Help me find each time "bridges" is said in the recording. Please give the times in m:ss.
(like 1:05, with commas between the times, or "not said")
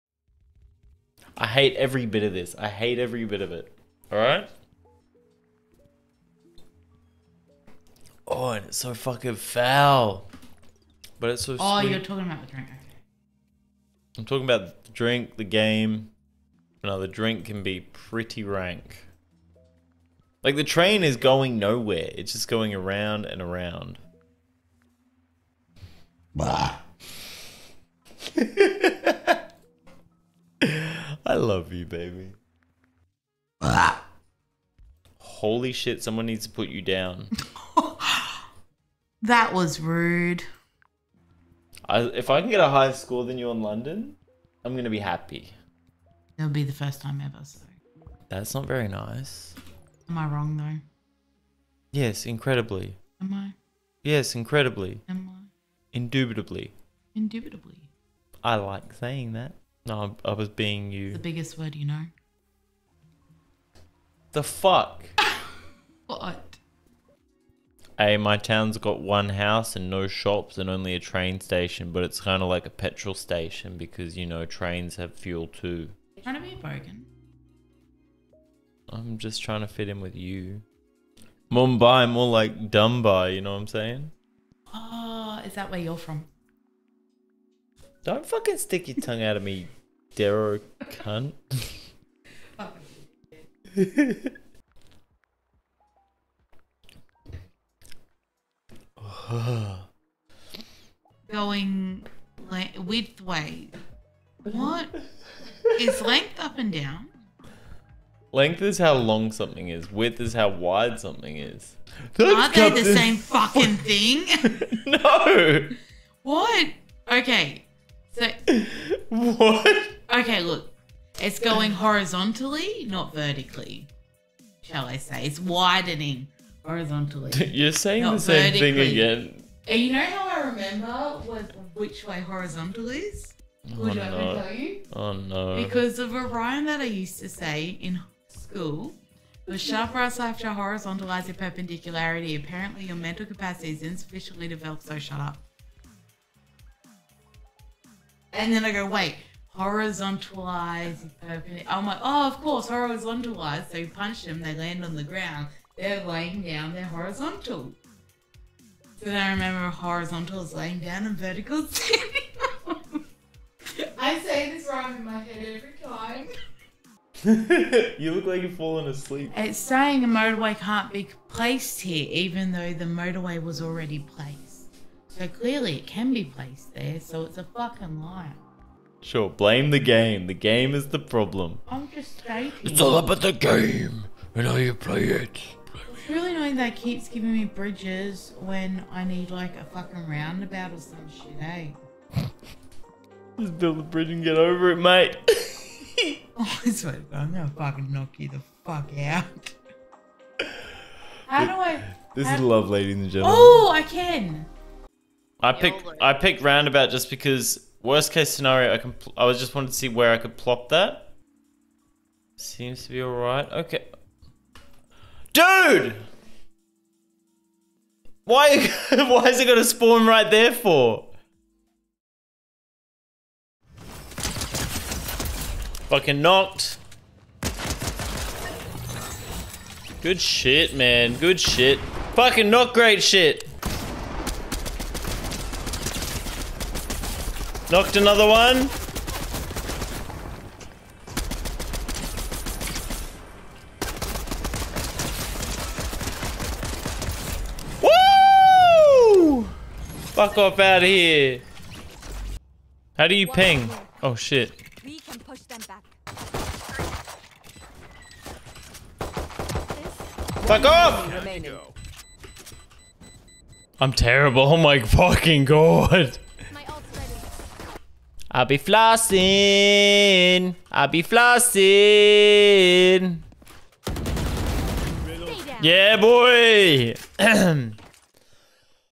3:07, 3:13.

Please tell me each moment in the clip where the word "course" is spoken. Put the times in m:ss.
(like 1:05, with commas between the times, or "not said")
2:32.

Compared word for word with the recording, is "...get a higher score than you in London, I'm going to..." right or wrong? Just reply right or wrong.
right.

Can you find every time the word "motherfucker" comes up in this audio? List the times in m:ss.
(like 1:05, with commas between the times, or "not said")
not said.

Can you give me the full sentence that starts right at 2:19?
The sharp right side shall horizontalize your perpendicularity.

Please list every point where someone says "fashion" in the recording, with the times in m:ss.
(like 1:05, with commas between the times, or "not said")
not said.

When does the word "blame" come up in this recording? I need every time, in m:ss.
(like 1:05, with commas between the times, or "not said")
2:59.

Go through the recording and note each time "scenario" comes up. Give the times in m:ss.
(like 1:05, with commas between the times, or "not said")
3:28.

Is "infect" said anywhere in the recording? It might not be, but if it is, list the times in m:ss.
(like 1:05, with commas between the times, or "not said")
not said.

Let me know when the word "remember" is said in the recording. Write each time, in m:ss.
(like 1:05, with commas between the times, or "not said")
2:10, 2:39.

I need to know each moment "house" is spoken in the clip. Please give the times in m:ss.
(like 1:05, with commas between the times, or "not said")
1:09.